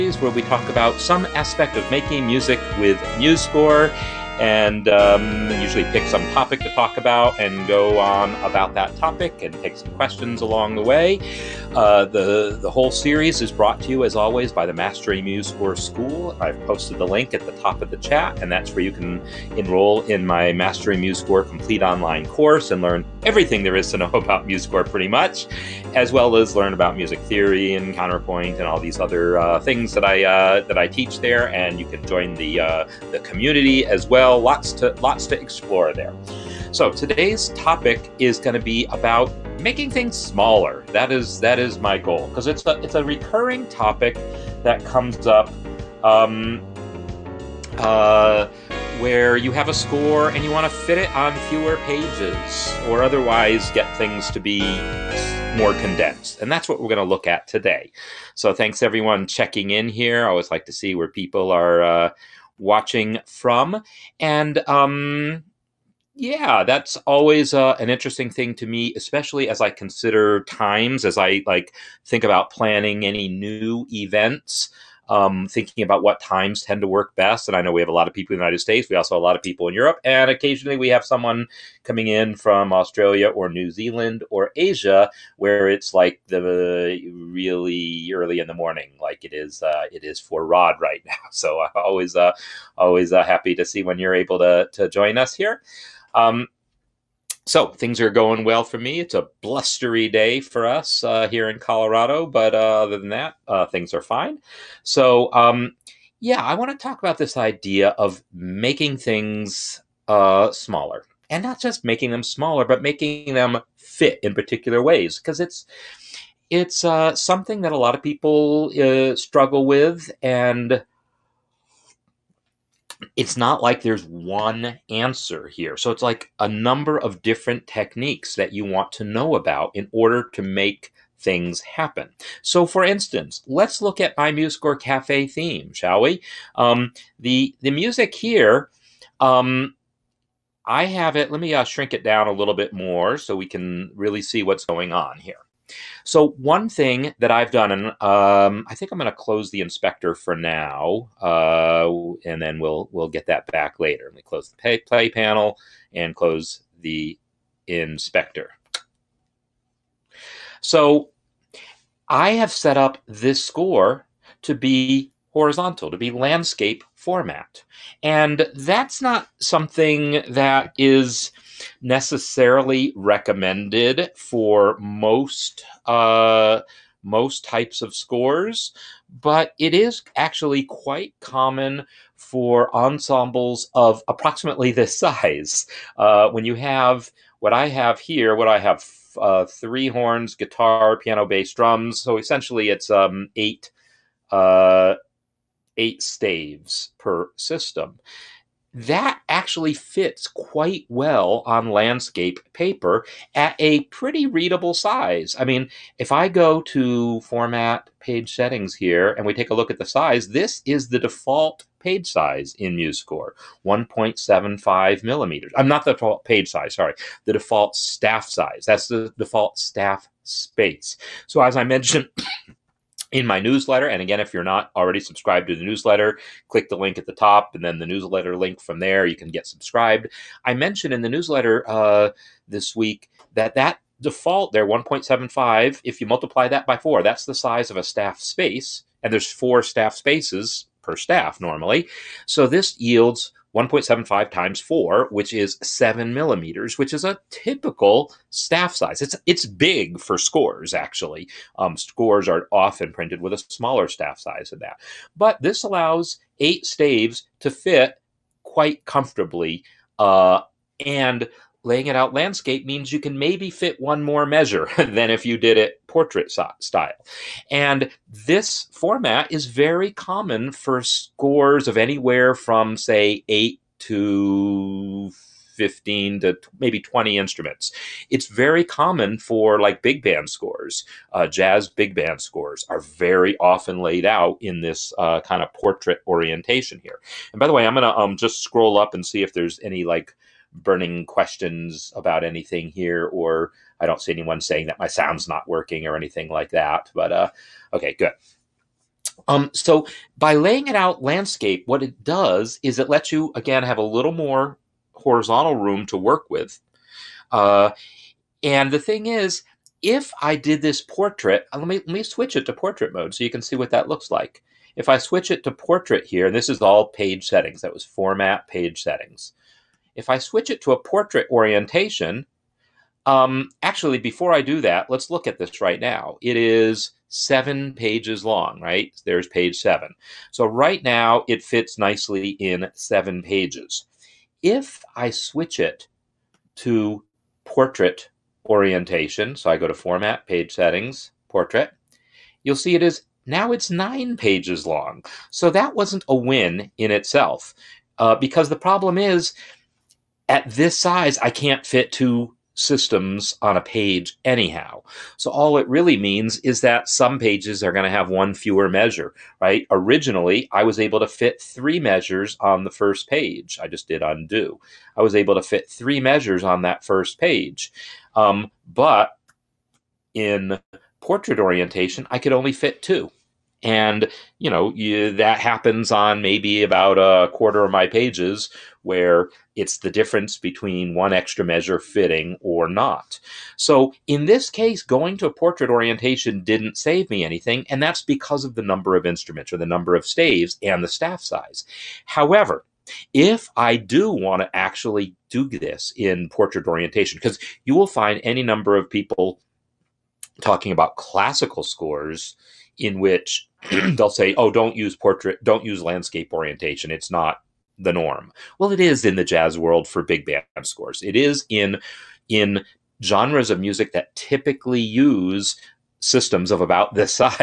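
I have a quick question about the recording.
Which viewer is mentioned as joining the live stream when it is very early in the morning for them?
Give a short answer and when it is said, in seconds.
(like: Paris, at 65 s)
Rod, at 90 s.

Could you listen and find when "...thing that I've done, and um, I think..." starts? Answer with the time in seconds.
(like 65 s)
146 s.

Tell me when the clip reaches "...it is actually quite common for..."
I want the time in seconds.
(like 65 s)
179 s.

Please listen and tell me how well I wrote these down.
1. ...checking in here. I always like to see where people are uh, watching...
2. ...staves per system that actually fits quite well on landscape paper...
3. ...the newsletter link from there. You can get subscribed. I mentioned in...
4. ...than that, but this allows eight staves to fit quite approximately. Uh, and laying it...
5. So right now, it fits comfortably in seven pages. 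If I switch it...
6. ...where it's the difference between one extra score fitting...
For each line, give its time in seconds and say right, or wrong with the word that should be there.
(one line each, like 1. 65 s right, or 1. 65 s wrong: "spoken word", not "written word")
1. 59 s right
2. 196 s right
3. 227 s right
4. 254 s wrong: "comfortably", not "approximately"
5. 330 s wrong: "nicely", not "comfortably"
6. 378 s wrong: "measure", not "score".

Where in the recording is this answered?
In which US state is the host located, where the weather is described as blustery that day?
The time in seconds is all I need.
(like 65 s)
101 s.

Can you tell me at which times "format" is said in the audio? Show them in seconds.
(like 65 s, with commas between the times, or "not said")
166 s, 207 s, 268 s, 317 s, 339 s.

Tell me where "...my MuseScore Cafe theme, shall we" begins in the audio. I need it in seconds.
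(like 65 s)
134 s.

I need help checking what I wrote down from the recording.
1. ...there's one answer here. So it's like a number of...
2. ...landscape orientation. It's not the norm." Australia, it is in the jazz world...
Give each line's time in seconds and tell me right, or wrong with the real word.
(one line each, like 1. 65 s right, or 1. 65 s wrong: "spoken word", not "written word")
1. 123 s right
2. 405 s wrong: "Well", not "Australia".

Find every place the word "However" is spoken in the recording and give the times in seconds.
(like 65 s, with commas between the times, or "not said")
392 s.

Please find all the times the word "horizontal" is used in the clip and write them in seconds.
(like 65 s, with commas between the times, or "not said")
165 s, 304 s.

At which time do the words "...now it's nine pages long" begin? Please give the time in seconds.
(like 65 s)
343 s.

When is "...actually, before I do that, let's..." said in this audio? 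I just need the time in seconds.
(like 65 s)
323 s.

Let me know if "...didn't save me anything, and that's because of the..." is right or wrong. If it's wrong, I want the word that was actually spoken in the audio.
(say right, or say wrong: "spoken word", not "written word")
right.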